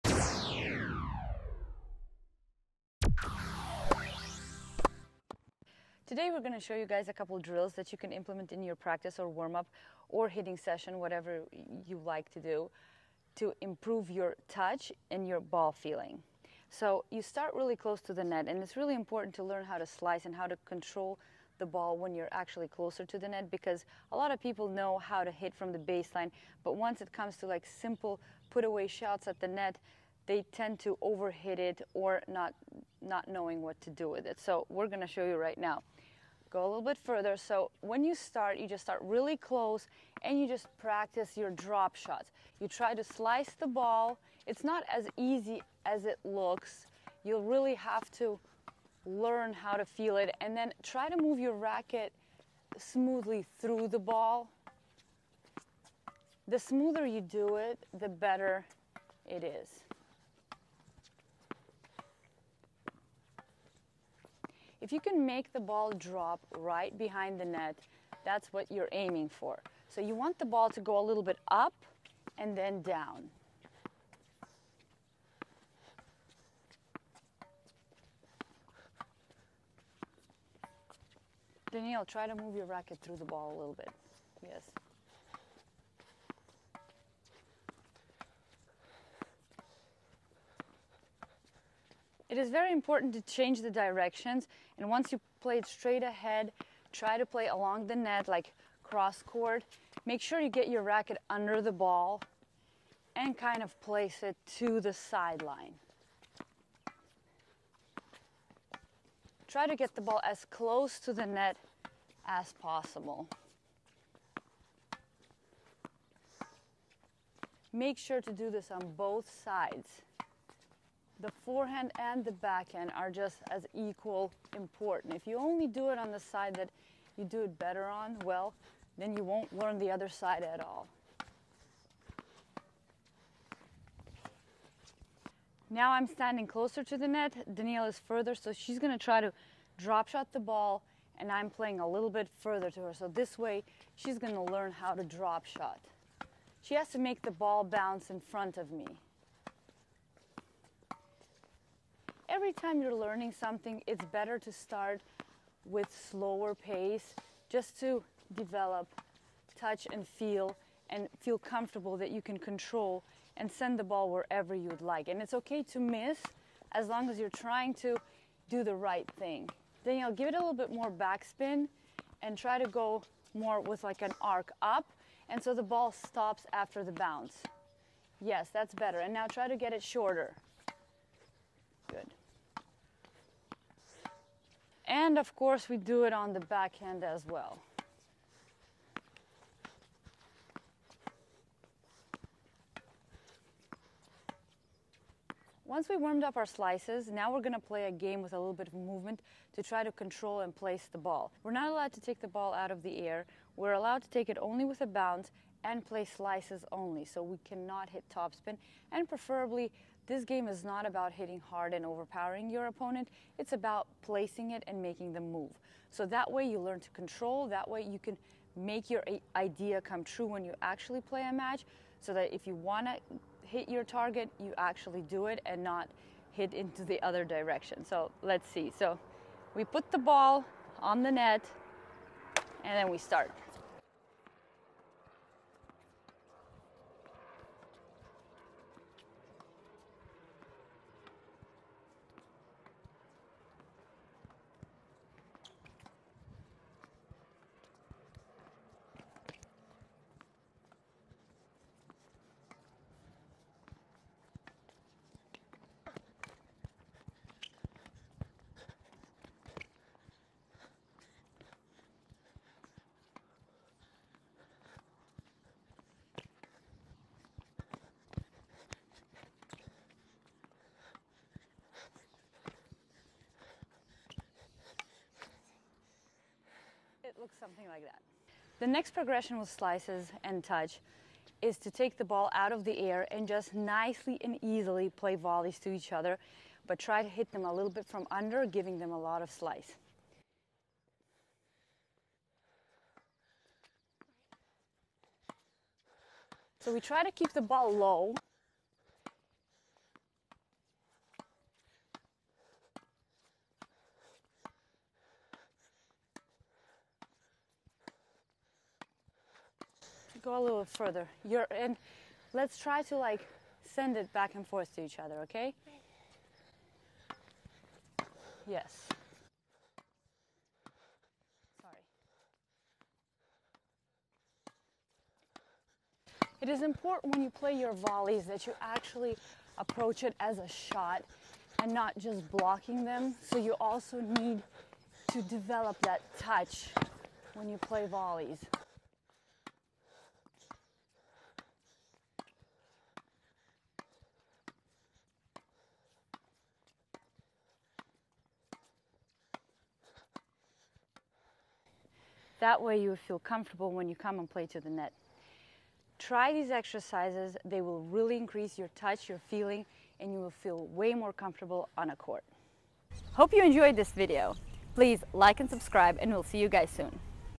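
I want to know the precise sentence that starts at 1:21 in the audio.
Danielle, try to move your racket through the ball a little bit.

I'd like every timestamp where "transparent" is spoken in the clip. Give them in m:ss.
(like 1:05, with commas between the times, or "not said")
not said.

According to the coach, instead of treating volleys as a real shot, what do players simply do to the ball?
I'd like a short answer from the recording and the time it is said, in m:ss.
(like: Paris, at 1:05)
Blocking them, at 5:32.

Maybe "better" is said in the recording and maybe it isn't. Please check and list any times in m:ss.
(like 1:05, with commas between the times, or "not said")
0:58, 2:07, 2:34, 2:58.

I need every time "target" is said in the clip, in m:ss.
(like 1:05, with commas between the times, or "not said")
3:43.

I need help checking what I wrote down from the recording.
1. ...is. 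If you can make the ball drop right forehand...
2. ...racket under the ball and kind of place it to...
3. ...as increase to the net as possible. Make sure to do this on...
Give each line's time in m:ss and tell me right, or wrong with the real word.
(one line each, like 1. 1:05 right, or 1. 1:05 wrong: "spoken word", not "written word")
1. 0:59 wrong: "behind", not "forehand"
2. 1:40 right
3. 1:50 wrong: "close", not "increase".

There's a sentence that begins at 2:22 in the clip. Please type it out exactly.
So this way, she's gonna learn how to drop shot.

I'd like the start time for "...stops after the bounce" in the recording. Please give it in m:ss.
2:55.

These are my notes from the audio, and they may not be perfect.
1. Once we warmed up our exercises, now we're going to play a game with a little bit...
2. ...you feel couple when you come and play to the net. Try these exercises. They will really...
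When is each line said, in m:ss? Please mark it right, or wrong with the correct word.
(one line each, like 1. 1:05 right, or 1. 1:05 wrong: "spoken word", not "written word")
1. 3:15 wrong: "slices", not "exercises"
2. 5:52 wrong: "comfortable", not "couple".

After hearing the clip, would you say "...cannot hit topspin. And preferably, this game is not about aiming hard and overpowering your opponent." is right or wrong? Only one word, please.
wrong.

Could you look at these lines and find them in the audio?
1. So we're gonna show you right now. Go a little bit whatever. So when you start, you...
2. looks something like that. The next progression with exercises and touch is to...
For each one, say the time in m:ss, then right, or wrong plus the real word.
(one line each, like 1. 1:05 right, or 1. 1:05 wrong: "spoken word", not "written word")
1. 0:34 wrong: "further", not "whatever"
2. 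4:37 wrong: "slices", not "exercises".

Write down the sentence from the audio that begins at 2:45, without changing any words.
And it's okay to miss as long as you're trying to do the right thing.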